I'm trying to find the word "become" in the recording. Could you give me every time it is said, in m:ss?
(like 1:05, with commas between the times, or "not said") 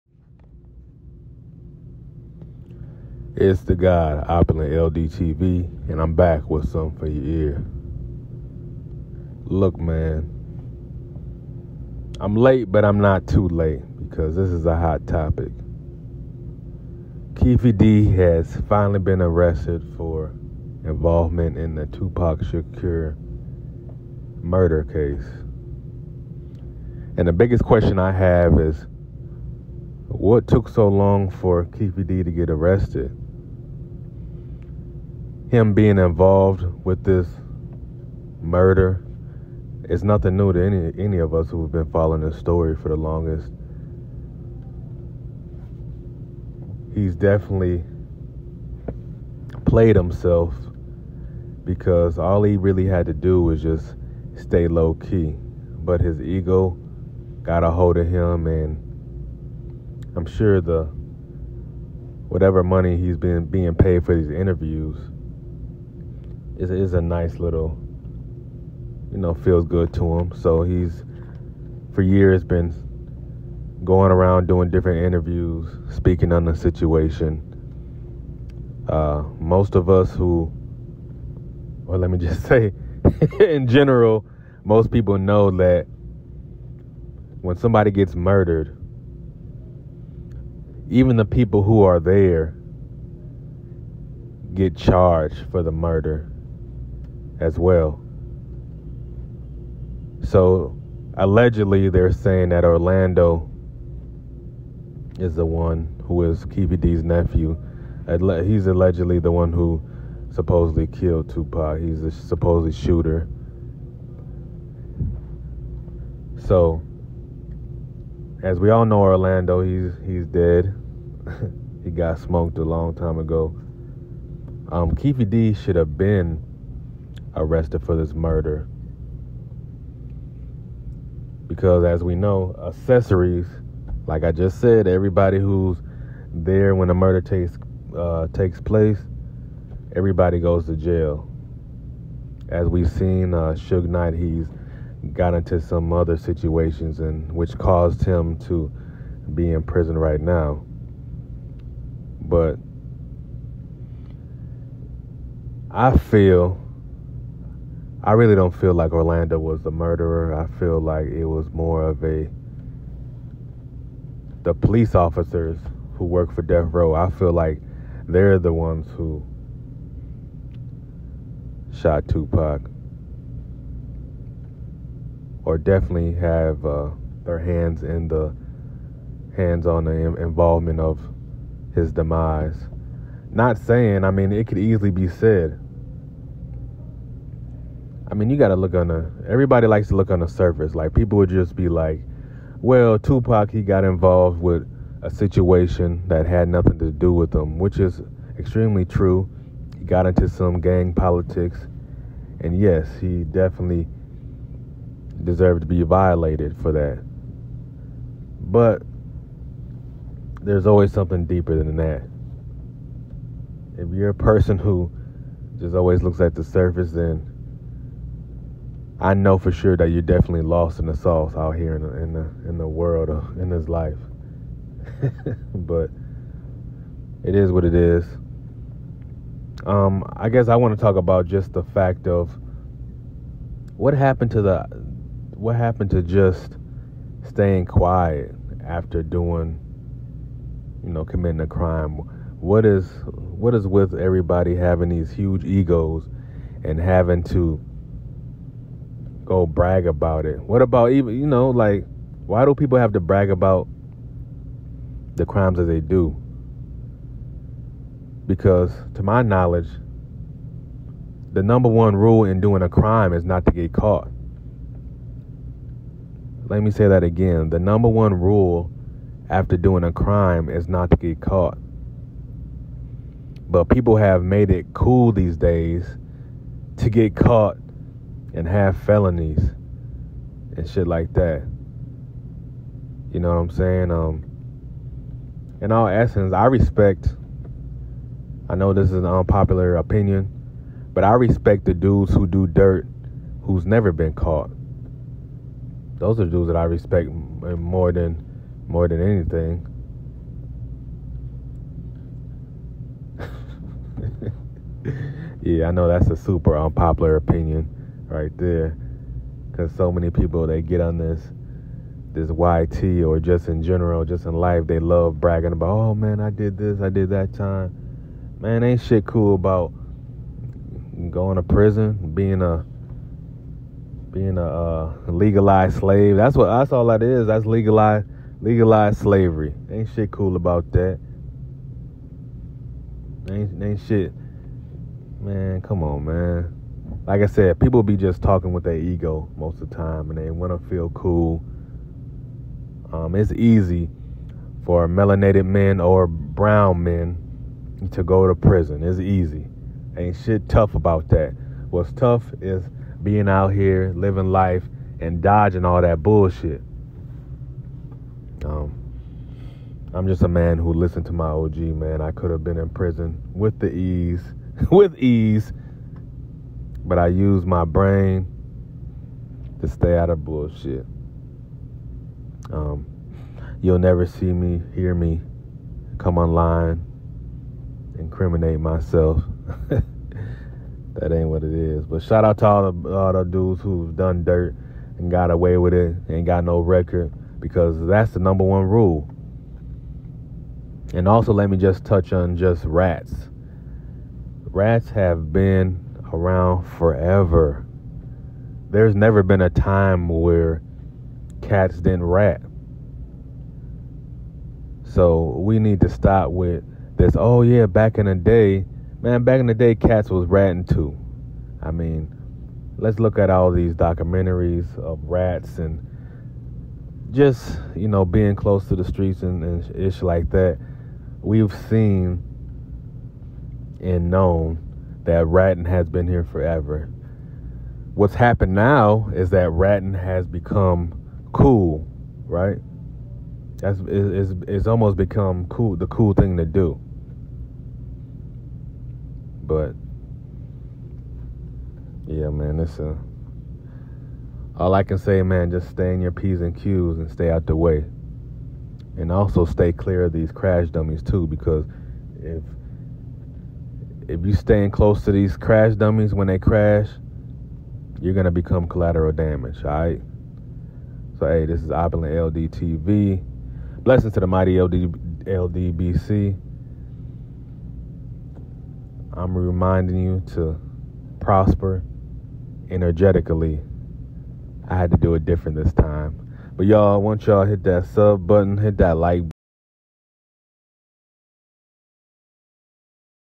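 7:10, 7:14, 7:38.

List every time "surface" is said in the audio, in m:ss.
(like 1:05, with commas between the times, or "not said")
3:10, 3:36.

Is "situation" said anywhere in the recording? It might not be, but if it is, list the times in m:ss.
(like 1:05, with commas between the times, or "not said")
1:16, 2:26, 3:15.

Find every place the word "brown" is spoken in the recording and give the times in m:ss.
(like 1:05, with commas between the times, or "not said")
5:46.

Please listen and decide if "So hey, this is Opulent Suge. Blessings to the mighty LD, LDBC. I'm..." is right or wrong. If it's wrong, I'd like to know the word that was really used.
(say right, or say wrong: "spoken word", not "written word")
wrong: "LDTV", not "Suge".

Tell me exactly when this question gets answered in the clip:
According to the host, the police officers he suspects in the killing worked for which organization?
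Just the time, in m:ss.
2:46.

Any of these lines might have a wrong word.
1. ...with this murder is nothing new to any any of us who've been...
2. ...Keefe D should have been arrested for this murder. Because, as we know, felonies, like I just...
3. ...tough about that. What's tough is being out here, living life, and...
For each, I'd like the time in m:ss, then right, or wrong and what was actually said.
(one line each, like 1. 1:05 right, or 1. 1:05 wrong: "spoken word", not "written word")
1. 0:36 right
2. 2:04 wrong: "accessories", not "felonies"
3. 5:50 right.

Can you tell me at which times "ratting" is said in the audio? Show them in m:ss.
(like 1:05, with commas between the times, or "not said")
6:50, 7:05, 7:09.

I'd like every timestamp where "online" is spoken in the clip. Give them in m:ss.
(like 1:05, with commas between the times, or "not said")
6:16.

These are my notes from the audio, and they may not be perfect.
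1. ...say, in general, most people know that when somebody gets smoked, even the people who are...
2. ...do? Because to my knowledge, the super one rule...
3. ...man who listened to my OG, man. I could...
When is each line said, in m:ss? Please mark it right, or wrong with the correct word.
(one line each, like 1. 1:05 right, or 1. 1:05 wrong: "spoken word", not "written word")
1. 1:22 wrong: "murdered", not "smoked"
2. 4:15 wrong: "number", not "super"
3. 6:00 right.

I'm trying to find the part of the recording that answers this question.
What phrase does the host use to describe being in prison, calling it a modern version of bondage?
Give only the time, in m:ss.
5:28.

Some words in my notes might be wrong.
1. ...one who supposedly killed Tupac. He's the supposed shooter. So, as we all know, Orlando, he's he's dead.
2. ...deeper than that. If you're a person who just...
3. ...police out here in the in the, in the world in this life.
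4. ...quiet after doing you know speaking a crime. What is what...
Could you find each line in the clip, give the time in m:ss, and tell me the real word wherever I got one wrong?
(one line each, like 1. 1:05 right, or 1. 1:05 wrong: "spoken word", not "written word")
1. 1:49 right
2. 3:31 right
3. 3:40 wrong: "sauce", not "police"
4. 3:57 wrong: "committing", not "speaking".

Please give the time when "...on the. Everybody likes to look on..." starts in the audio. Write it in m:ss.
3:08.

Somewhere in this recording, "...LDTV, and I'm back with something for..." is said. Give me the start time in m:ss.
0:04.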